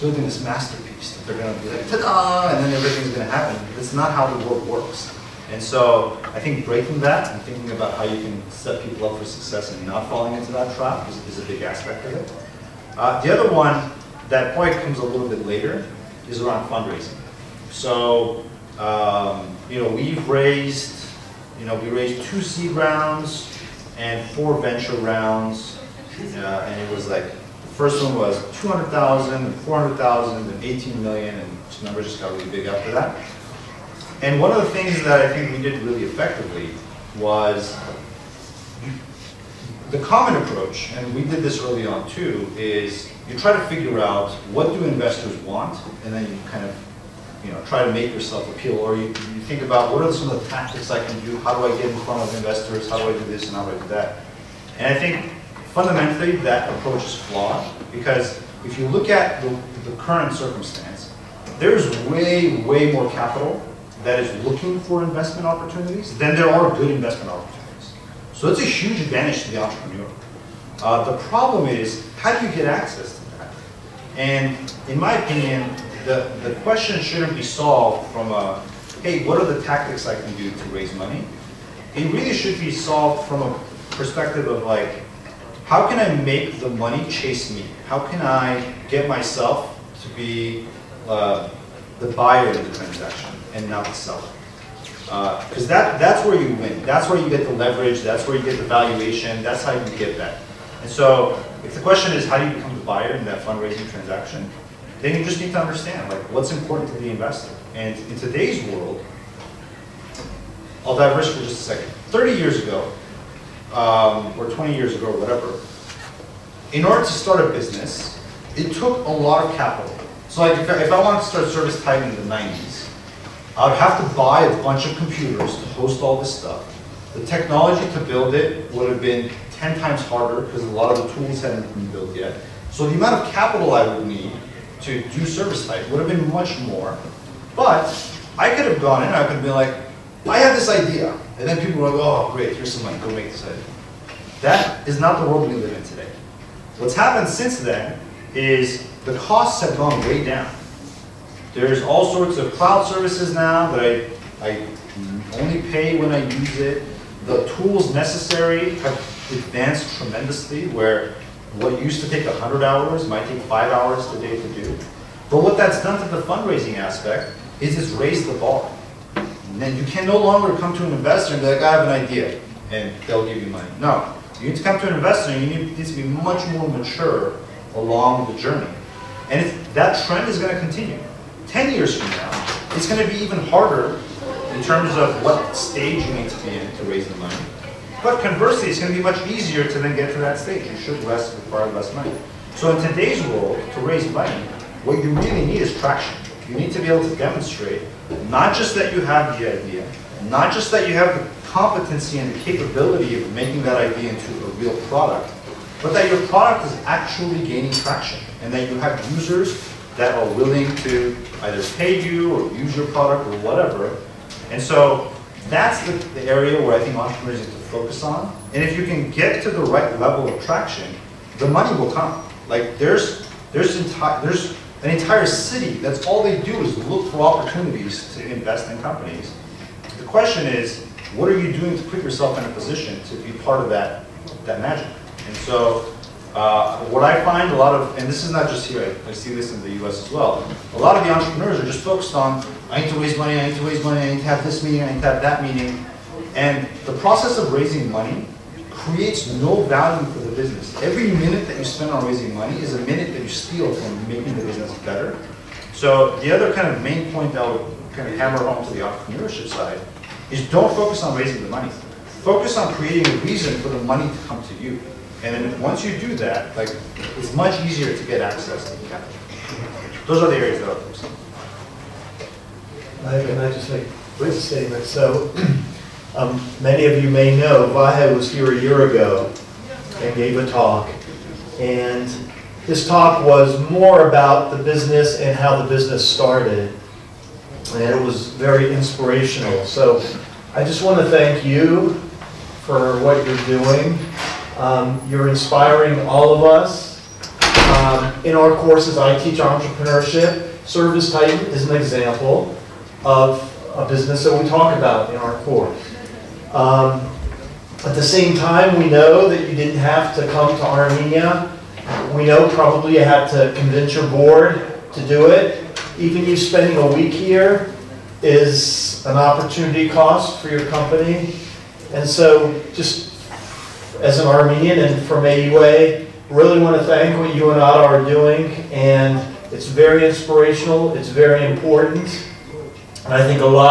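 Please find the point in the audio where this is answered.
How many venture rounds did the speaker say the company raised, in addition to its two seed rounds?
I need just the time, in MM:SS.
00:24.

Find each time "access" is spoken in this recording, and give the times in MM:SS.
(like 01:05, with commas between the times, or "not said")
01:12, 04:28.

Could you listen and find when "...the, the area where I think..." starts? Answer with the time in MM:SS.
03:35.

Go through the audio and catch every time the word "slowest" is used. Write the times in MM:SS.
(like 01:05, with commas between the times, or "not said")
not said.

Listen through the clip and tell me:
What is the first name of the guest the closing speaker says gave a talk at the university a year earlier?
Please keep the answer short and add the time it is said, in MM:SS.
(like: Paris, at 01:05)
Vahe, at 04:37.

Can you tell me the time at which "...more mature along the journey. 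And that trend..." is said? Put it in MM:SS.
02:56.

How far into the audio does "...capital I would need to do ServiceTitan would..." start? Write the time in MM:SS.
02:13.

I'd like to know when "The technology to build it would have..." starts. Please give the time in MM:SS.
02:07.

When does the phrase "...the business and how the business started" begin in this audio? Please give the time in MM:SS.
04:44.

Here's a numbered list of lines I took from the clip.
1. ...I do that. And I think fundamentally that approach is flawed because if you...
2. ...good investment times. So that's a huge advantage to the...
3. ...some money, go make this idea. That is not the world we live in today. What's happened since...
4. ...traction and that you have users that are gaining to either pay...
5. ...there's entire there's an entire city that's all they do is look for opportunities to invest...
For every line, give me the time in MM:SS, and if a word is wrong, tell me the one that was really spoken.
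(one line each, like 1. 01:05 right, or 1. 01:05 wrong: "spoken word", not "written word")
1. 00:53 right
2. 01:06 wrong: "opportunities", not "times"
3. 02:22 right
4. 03:27 wrong: "willing", not "gaining"
5. 03:43 right.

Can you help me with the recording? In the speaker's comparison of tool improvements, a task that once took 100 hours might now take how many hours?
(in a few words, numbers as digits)
5.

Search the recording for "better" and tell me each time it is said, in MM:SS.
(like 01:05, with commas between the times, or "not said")
04:14.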